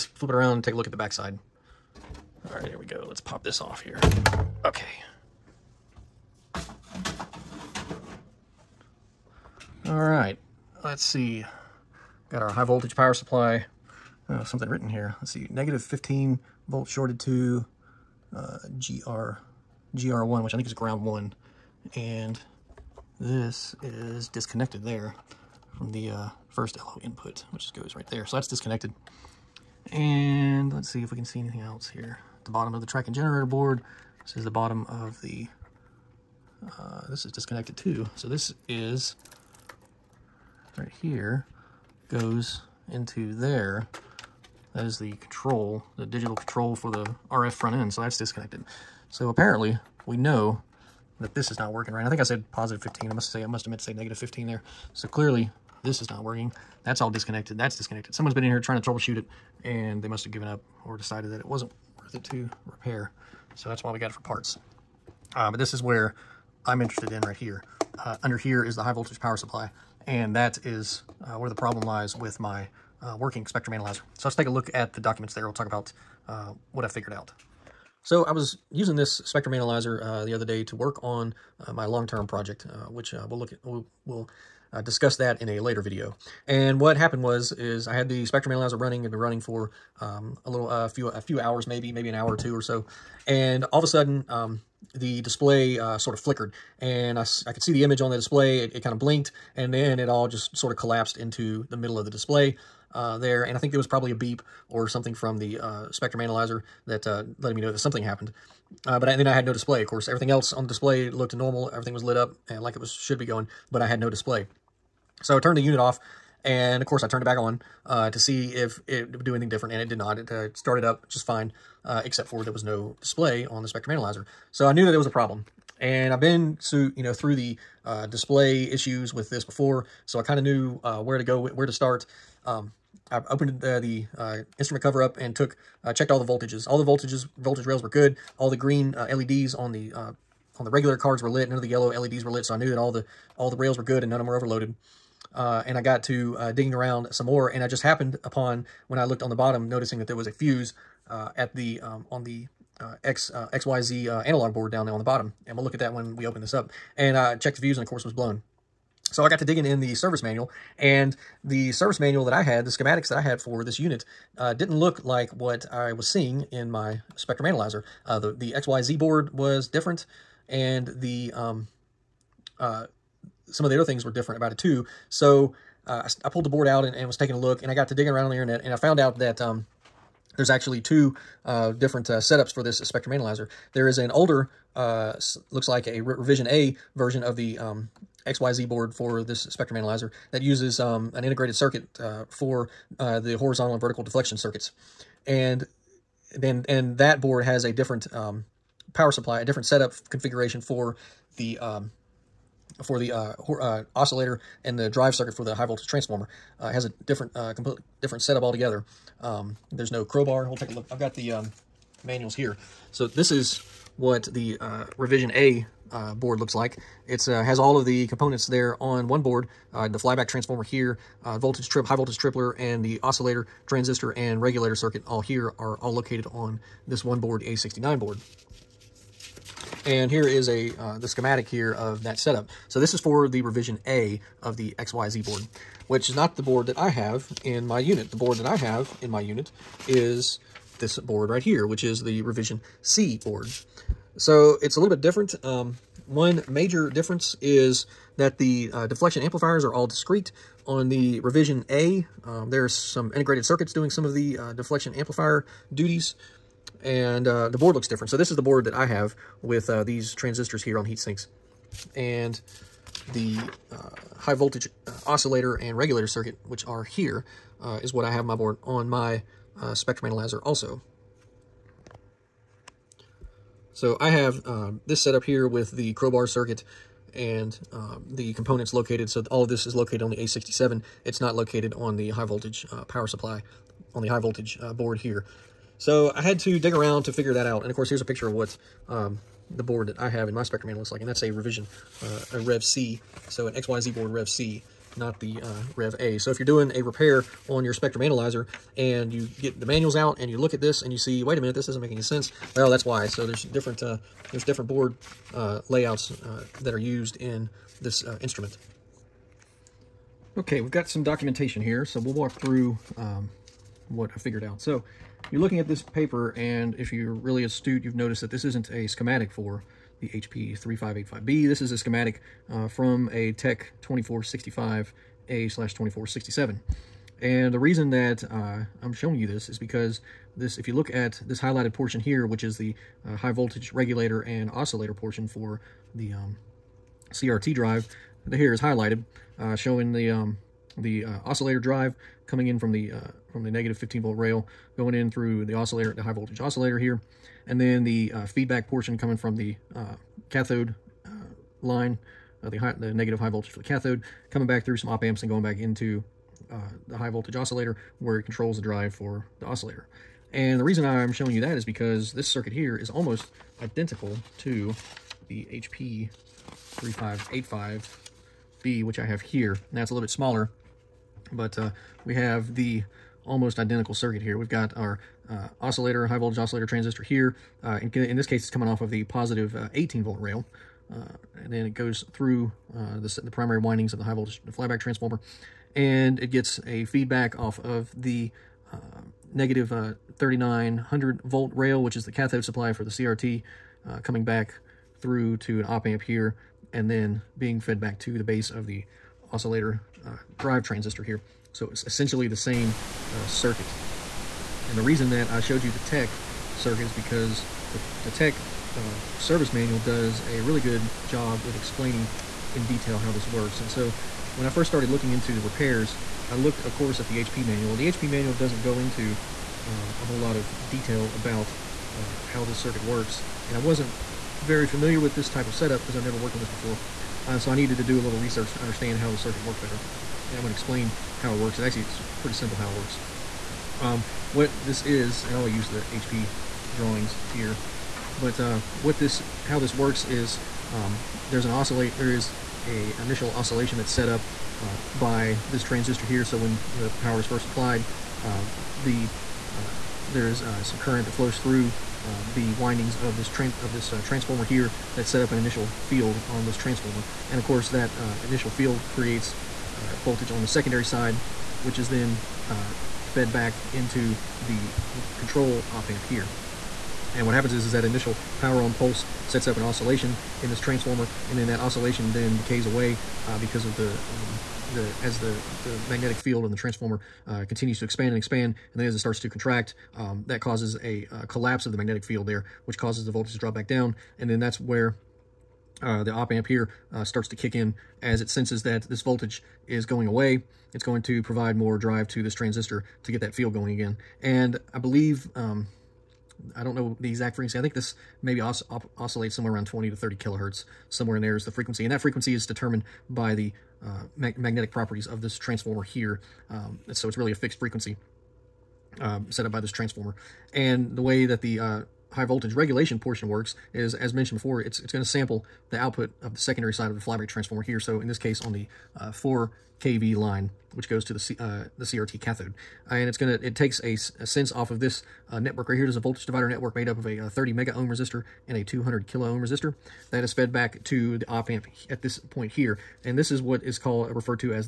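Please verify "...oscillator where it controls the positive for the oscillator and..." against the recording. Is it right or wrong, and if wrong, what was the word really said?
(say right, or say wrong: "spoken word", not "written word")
wrong: "drive", not "positive".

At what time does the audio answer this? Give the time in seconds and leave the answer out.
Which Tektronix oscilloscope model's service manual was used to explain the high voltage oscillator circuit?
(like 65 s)
323 s.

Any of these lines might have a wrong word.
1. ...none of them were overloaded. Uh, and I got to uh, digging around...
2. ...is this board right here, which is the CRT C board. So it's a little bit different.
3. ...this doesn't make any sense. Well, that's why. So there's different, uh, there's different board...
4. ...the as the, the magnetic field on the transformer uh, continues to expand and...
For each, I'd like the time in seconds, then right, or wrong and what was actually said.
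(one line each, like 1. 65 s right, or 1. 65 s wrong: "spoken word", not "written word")
1. 144 s right
2. 239 s wrong: "Revision", not "CRT"
3. 301 s right
4. 474 s right.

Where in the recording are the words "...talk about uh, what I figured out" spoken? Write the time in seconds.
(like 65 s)
75 s.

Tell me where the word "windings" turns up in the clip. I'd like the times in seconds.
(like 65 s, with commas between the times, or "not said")
383 s, 452 s.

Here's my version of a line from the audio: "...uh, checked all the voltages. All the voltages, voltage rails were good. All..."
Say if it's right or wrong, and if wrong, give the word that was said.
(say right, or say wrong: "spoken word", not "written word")
right.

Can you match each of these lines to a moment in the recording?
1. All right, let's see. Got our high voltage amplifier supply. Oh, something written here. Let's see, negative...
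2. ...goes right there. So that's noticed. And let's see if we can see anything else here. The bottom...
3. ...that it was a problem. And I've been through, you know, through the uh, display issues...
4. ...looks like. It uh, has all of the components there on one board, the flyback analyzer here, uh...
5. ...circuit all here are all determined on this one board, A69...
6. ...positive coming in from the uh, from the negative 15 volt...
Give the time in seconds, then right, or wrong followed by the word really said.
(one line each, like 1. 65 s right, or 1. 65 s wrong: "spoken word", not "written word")
1. 9 s wrong: "power", not "amplifier"
2. 27 s wrong: "disconnected", not "noticed"
3. 124 s right
4. 216 s wrong: "transformer", not "analyzer"
5. 224 s wrong: "located", not "determined"
6. 341 s wrong: "drive", not "positive".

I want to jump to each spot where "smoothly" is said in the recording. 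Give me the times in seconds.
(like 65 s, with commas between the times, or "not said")
not said.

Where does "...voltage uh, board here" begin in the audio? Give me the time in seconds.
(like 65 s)
284 s.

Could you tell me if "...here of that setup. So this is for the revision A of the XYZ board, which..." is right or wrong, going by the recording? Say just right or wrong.
right.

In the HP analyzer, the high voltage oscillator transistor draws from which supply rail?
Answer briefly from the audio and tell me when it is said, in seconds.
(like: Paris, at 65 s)
positive 18 volt, at 379 s.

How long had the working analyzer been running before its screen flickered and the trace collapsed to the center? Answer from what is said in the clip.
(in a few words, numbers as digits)
an hour or two.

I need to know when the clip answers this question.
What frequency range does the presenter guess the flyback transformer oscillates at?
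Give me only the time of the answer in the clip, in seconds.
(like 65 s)
499 s.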